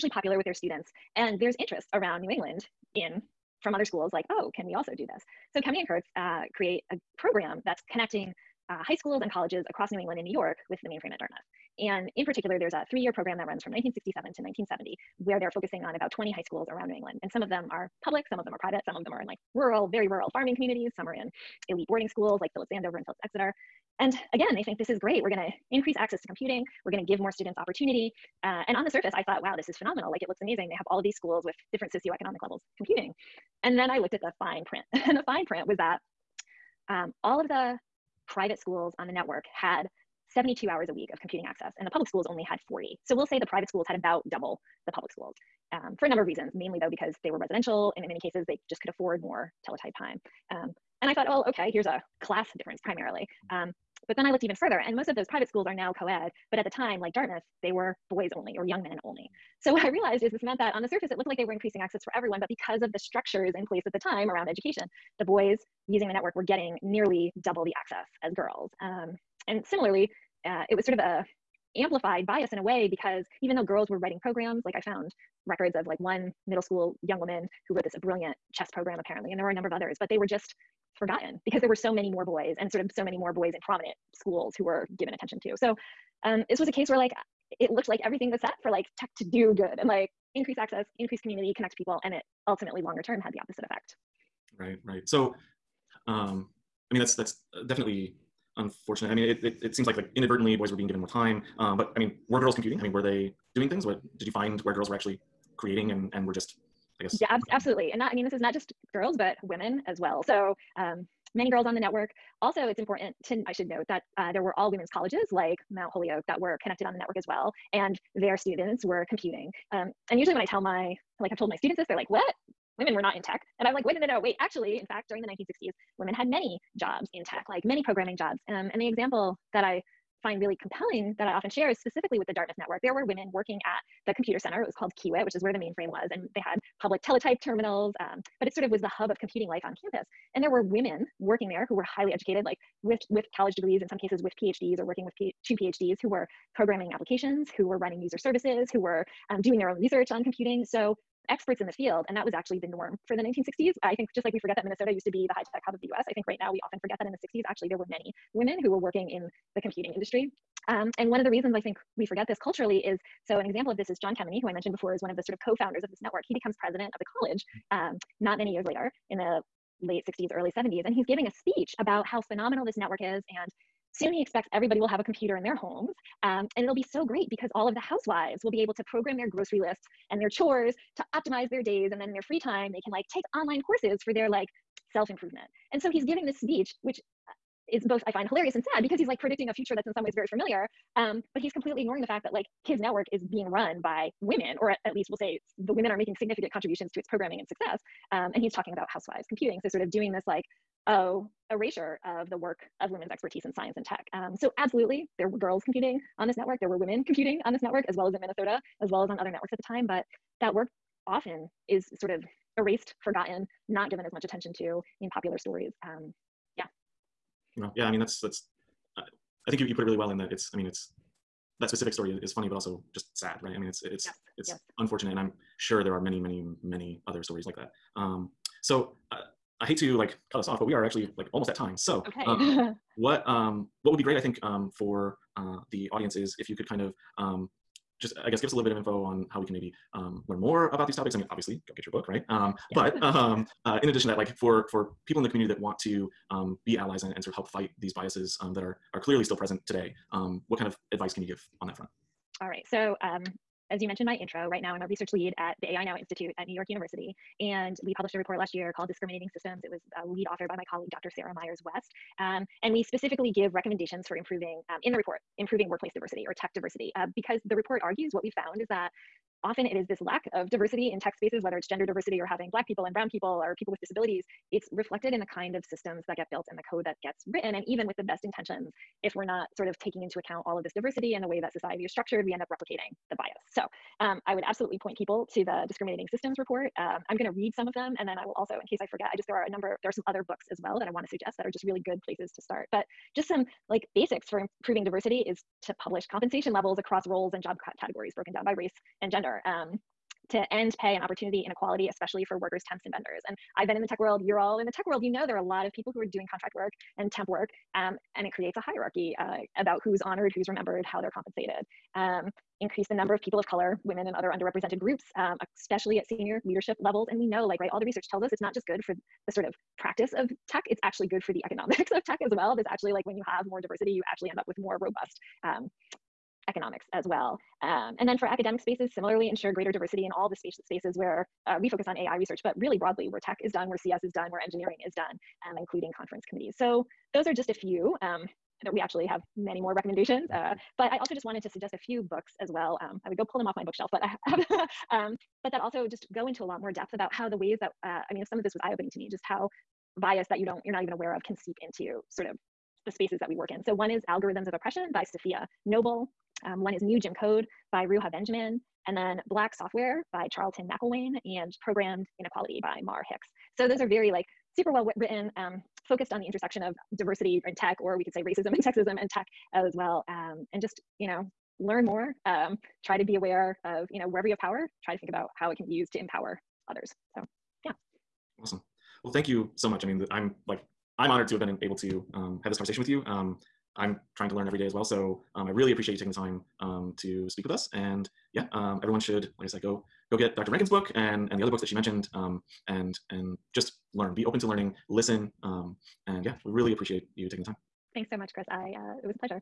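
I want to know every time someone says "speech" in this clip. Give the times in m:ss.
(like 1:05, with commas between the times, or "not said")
2:51, 3:06.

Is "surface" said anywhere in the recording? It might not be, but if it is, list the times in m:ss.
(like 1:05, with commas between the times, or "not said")
0:28, 1:00.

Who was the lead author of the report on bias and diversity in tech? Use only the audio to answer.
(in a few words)
Sarah Myers West.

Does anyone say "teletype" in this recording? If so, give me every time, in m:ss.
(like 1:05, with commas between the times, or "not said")
0:49, 2:17.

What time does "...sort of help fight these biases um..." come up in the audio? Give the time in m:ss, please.
4:07.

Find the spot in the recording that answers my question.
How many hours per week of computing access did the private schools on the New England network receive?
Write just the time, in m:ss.
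0:40.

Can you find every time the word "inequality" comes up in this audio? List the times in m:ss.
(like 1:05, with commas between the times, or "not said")
5:01, 6:02.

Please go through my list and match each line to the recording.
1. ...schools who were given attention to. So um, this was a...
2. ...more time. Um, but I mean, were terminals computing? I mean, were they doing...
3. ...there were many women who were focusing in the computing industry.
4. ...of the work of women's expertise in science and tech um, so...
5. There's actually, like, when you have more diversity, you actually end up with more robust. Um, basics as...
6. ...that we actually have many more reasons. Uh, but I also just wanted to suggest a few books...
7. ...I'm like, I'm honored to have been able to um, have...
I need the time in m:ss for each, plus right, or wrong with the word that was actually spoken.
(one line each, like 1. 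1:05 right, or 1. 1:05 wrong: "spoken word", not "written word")
1. 1:24 right
2. 1:40 wrong: "girls", not "terminals"
3. 2:37 wrong: "working", not "focusing"
4. 3:22 right
5. 5:22 wrong: "economics", not "basics"
6. 5:38 wrong: "recommendations", not "reasons"
7. 6:20 right.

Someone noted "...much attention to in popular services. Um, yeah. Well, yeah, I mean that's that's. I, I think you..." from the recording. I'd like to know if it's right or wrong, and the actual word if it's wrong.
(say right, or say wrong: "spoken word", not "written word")
wrong: "stories", not "services".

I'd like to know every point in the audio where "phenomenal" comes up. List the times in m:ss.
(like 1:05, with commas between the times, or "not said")
0:29, 2:52.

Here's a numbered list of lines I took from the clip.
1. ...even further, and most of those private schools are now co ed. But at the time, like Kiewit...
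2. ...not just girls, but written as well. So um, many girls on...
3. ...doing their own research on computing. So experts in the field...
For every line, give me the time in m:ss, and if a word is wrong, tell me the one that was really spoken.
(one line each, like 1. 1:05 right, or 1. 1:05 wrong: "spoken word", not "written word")
1. 0:54 wrong: "Dartmouth", not "Kiewit"
2. 1:48 wrong: "women", not "written"
3. 2:29 right.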